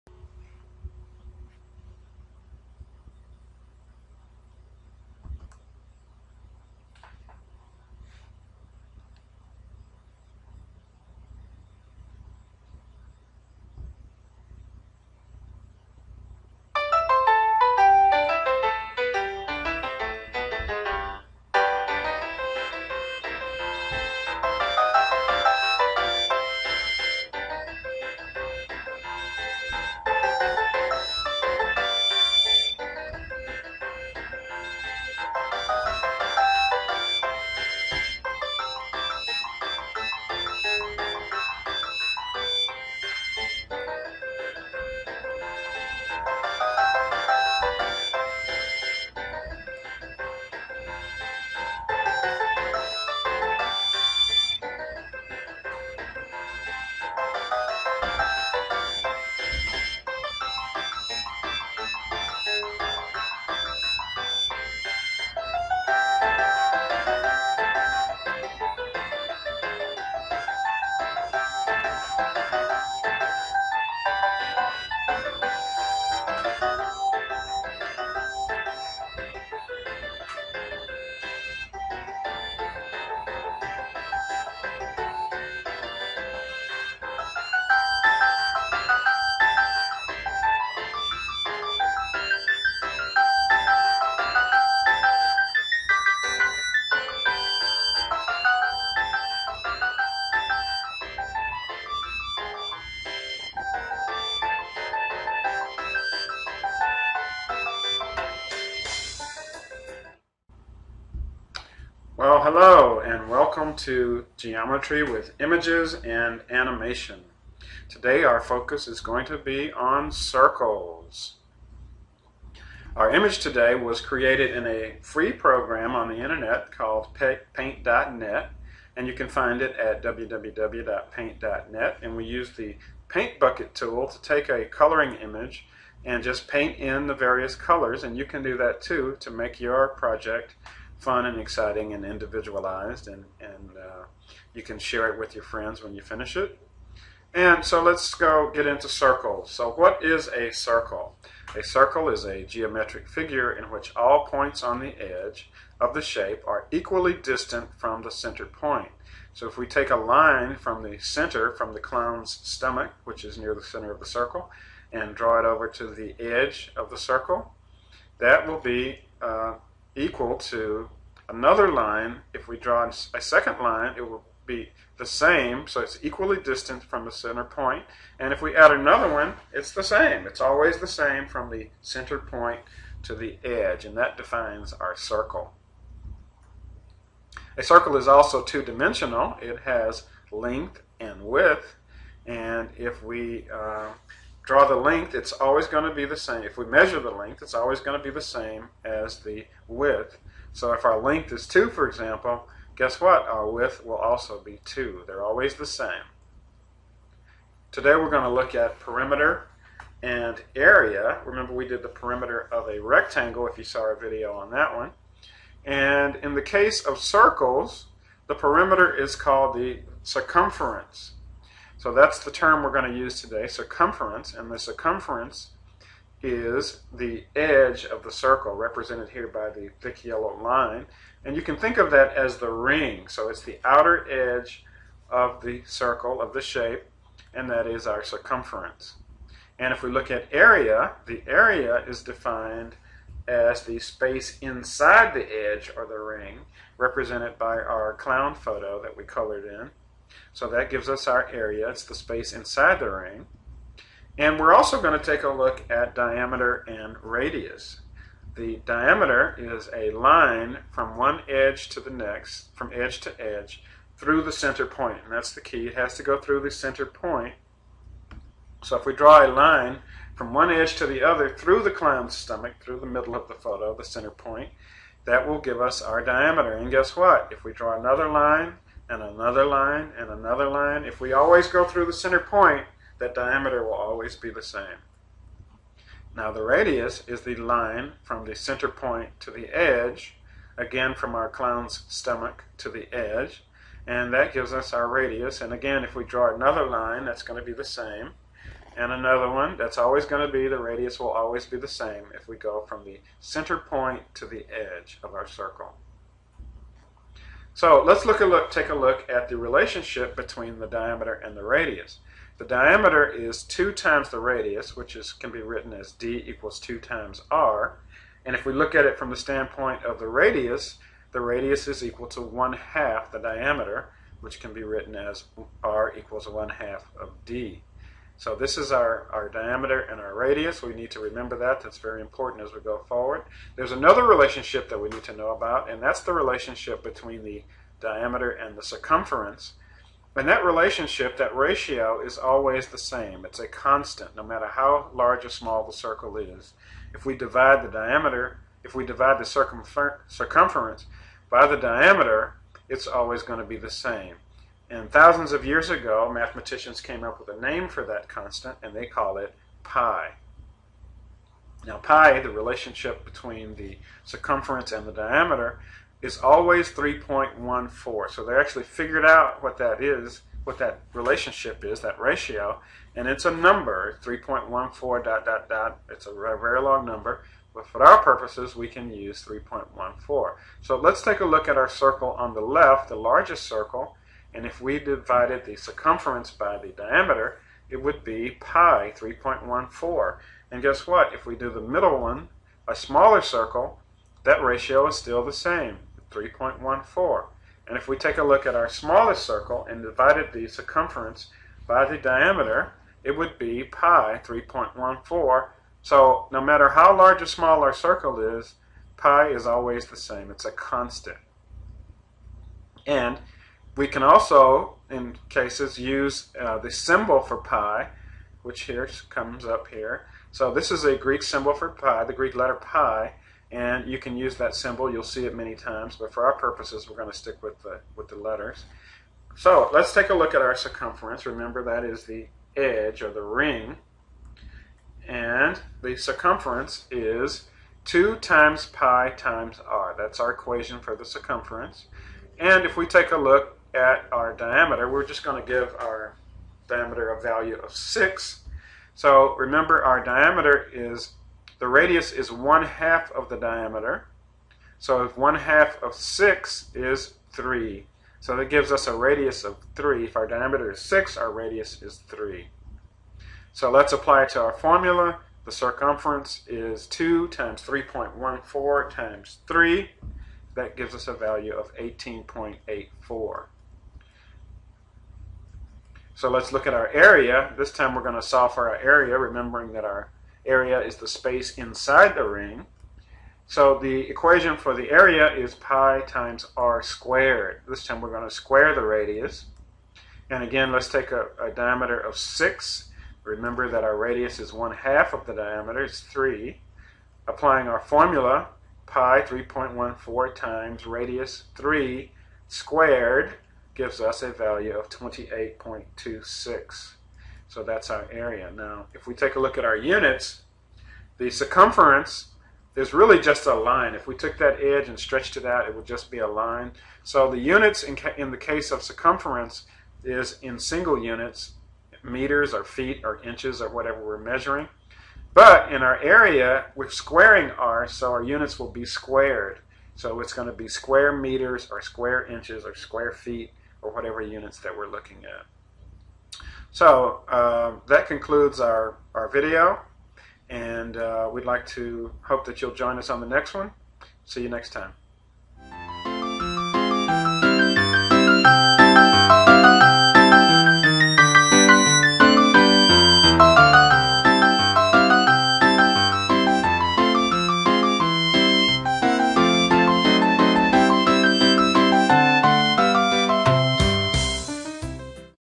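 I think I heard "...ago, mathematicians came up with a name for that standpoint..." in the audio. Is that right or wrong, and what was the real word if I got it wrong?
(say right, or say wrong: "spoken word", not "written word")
wrong: "constant", not "standpoint".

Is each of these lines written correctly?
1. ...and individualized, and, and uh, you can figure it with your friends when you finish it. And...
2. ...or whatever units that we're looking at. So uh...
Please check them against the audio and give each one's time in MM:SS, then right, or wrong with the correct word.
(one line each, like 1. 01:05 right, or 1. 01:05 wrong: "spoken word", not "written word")
1. 02:21 wrong: "share", not "figure"
2. 08:53 right.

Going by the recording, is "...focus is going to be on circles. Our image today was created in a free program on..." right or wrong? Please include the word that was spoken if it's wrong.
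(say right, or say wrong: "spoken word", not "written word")
right.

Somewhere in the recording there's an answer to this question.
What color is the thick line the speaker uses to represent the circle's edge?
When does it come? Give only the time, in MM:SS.
03:49.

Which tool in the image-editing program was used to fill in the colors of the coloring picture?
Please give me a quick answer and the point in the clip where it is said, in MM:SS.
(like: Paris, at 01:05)
paint bucket tool, at 02:13.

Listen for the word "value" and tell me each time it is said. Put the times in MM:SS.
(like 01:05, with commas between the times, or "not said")
07:27, 07:51, 08:24.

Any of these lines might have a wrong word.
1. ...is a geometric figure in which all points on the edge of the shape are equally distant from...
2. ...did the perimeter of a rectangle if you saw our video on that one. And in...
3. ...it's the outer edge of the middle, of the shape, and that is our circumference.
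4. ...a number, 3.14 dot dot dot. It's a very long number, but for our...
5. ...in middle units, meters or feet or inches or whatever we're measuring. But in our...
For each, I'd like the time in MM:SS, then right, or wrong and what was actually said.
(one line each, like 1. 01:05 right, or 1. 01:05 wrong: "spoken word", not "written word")
1. 02:32 right
2. 03:31 right
3. 03:53 wrong: "circle", not "middle"
4. 06:13 right
5. 08:40 wrong: "single", not "middle".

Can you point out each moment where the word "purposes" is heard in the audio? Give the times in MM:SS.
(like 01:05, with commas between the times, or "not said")
06:18, 07:06.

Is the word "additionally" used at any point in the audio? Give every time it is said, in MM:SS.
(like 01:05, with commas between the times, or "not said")
not said.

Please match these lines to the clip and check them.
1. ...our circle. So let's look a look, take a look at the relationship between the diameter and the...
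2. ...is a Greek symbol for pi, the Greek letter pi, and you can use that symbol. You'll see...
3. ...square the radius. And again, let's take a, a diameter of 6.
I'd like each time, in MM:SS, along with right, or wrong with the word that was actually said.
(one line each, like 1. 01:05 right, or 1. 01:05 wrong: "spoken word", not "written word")
1. 05:05 right
2. 07:00 right
3. 08:08 right.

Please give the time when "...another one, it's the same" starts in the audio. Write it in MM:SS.
02:58.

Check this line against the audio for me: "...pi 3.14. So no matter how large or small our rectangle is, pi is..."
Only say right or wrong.
wrong.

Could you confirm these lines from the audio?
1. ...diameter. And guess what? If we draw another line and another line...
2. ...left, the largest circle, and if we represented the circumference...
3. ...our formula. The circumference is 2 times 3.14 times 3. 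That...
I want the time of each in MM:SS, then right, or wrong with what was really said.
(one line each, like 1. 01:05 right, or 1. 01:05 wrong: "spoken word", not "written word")
1. 04:36 right
2. 06:22 wrong: "divided", not "represented"
3. 07:44 right.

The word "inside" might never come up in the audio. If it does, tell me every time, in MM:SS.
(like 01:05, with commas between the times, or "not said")
04:04, 04:12, 08:01.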